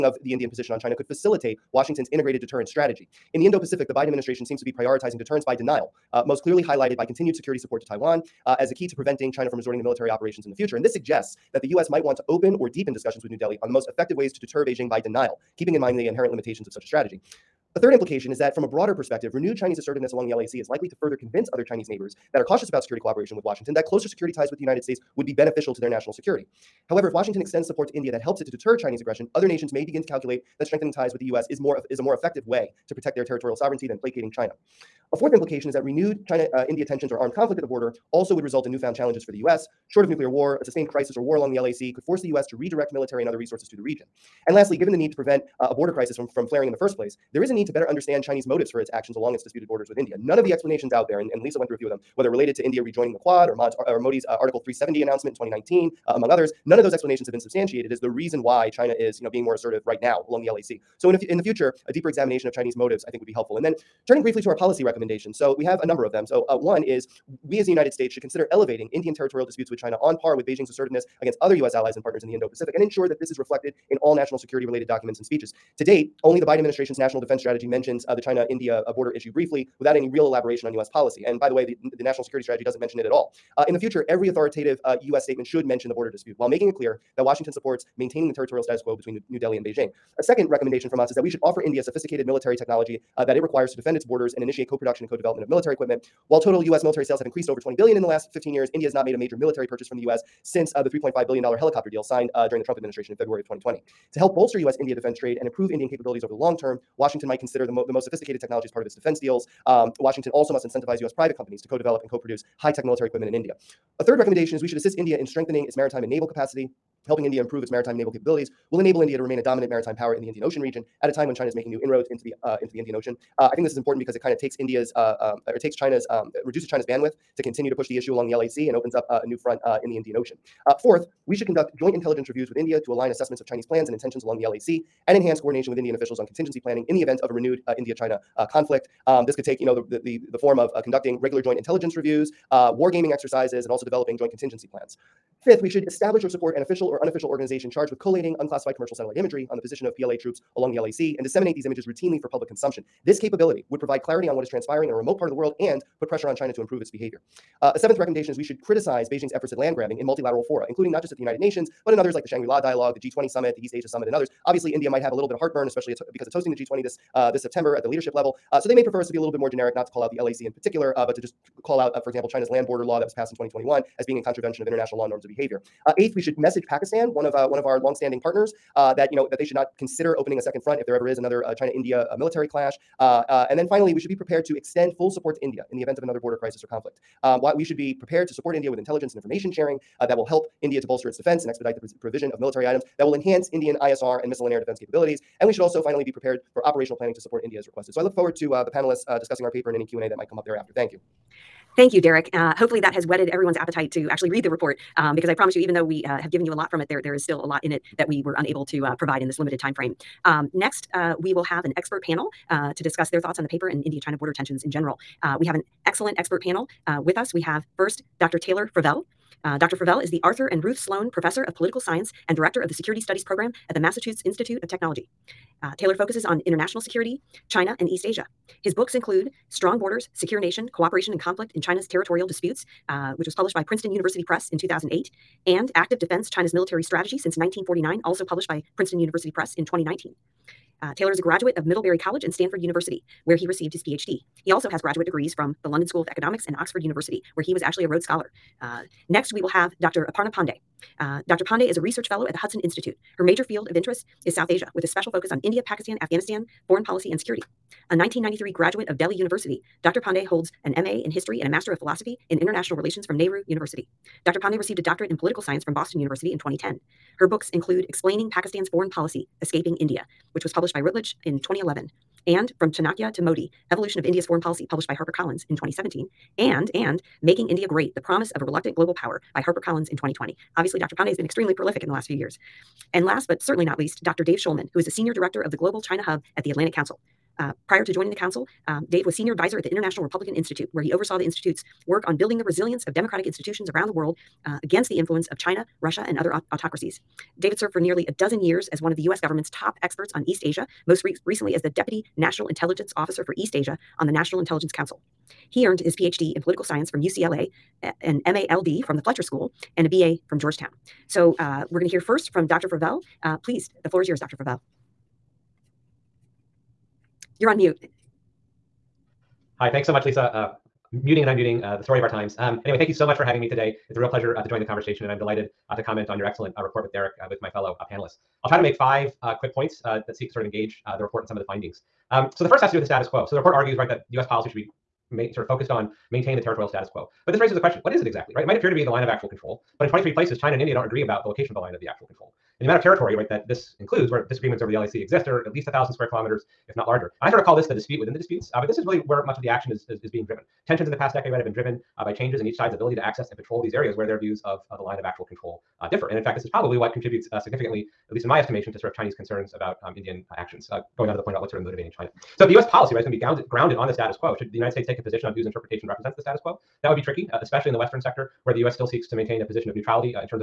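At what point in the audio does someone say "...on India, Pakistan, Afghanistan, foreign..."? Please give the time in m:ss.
4:15.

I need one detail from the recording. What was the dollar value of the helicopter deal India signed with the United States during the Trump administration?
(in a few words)
$3.5 billion.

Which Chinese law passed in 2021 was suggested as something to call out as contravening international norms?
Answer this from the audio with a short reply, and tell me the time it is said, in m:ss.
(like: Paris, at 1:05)
Land border law, at 2:52.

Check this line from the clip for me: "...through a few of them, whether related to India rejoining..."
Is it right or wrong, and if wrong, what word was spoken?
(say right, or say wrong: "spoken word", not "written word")
right.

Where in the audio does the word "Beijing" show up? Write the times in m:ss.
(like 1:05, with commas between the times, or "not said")
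0:14, 1:10, 1:29, 2:39.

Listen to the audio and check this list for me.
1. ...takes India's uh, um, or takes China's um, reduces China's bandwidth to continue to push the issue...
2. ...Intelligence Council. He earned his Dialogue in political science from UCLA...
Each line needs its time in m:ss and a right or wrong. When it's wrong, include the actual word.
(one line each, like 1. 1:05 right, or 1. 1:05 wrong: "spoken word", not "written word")
1. 2:04 right
2. 5:04 wrong: "PhD", not "Dialogue".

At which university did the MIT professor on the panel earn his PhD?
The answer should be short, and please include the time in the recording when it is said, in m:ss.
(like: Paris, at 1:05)
Stanford University, at 4:02.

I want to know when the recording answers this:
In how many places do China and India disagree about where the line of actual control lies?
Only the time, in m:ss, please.
5:39.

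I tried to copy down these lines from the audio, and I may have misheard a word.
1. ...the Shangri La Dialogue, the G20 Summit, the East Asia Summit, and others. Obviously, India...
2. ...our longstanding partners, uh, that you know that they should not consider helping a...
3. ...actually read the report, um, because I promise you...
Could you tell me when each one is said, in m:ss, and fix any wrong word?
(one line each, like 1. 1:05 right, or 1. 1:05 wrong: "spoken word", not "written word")
1. 2:42 right
2. 2:57 wrong: "opening", not "helping"
3. 3:24 right.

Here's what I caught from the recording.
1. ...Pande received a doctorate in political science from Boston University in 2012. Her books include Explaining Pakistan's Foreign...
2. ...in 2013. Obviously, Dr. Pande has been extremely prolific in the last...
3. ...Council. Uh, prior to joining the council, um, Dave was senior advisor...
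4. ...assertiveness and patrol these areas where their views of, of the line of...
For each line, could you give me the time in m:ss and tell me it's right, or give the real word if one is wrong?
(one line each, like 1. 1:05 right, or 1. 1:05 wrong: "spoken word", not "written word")
1. 4:24 wrong: "2010", not "2012"
2. 4:39 wrong: "2020", not "2013"
3. 4:46 right
4. 5:53 wrong: "access", not "assertiveness".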